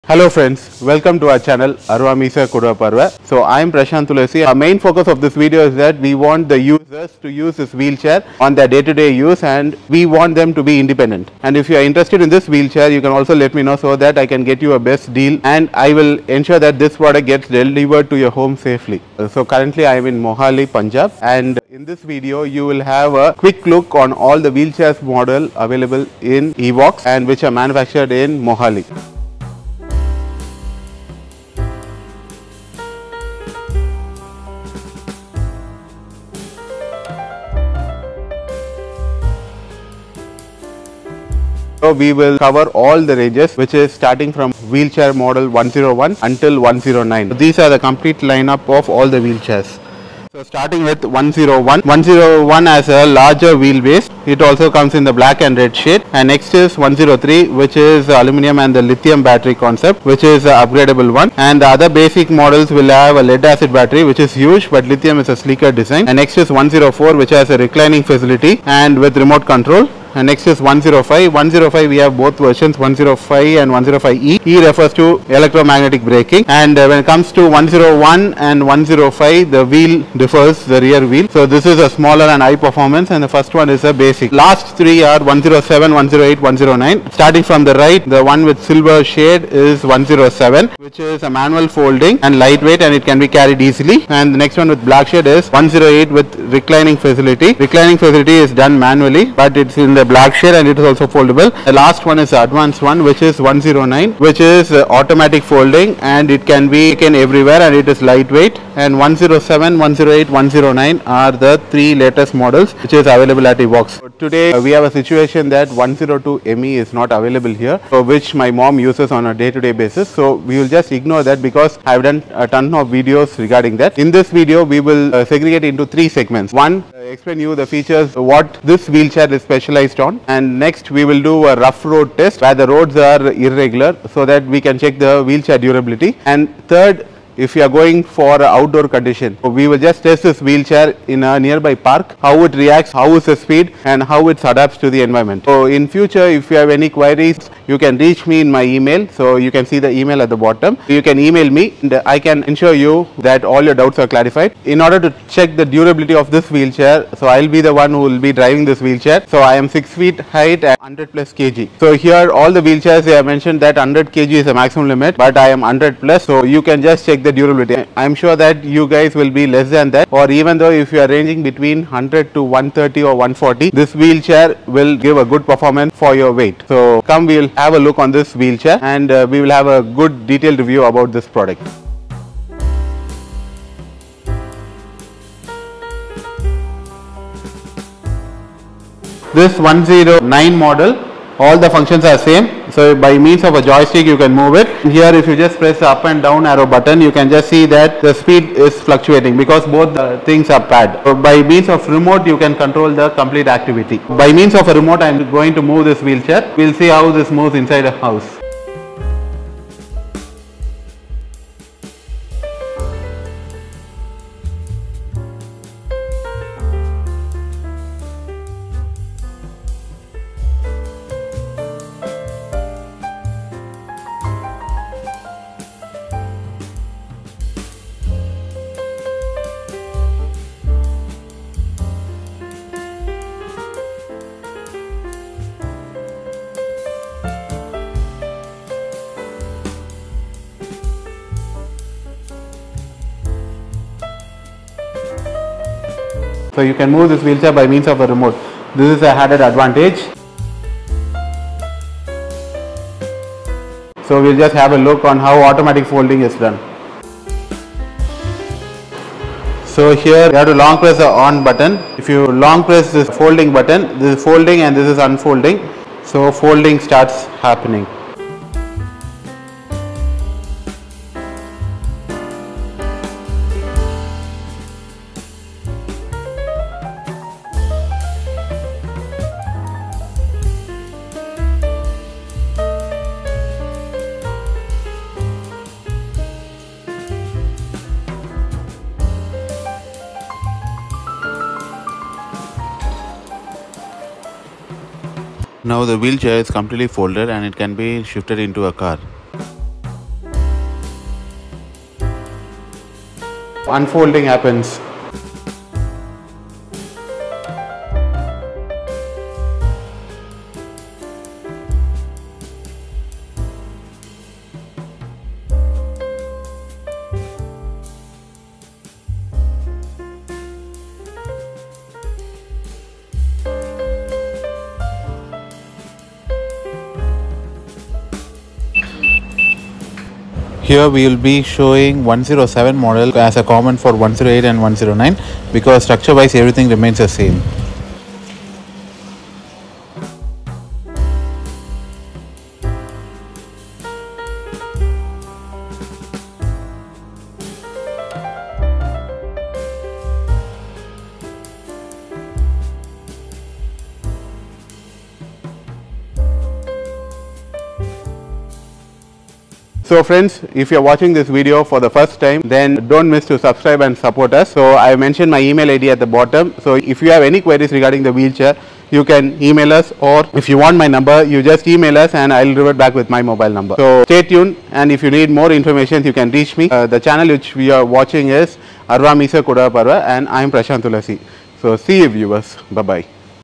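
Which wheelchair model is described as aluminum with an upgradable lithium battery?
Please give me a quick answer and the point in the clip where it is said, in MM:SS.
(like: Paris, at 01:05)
103, at 00:56.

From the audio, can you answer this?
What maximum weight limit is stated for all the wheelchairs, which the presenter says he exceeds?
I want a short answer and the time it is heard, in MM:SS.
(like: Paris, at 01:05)
100 kg, at 02:43.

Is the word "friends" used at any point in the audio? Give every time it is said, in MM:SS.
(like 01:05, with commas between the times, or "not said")
00:00, 06:00.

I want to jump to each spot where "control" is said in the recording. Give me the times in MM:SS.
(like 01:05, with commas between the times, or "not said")
01:09, 03:22.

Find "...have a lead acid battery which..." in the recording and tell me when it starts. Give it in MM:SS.
01:02.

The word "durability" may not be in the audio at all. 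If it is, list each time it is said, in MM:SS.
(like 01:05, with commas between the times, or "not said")
02:15, 02:35, 02:47.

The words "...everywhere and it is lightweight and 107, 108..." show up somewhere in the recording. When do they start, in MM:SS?
01:47.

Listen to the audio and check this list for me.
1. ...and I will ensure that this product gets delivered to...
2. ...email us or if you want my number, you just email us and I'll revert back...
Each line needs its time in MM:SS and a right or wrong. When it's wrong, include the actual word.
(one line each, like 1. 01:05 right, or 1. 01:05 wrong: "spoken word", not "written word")
1. 00:15 right
2. 06:09 right.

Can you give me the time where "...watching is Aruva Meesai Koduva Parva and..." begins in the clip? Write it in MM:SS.
06:17.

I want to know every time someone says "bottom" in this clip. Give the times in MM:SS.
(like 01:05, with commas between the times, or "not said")
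02:30, 06:06.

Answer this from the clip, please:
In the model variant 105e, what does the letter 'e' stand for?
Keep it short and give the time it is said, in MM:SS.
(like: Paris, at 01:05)
Electromagnetic braking, at 01:15.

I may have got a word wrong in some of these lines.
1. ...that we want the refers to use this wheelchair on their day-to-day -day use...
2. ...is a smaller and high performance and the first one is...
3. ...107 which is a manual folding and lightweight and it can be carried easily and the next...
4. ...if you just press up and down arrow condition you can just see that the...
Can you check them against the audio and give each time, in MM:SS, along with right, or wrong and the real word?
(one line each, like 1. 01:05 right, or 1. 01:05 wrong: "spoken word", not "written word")
1. 00:05 wrong: "users", not "refers"
2. 01:21 right
3. 01:29 right
4. 03:15 wrong: "button", not "condition".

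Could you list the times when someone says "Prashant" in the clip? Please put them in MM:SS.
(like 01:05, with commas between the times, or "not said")
00:03, 06:20.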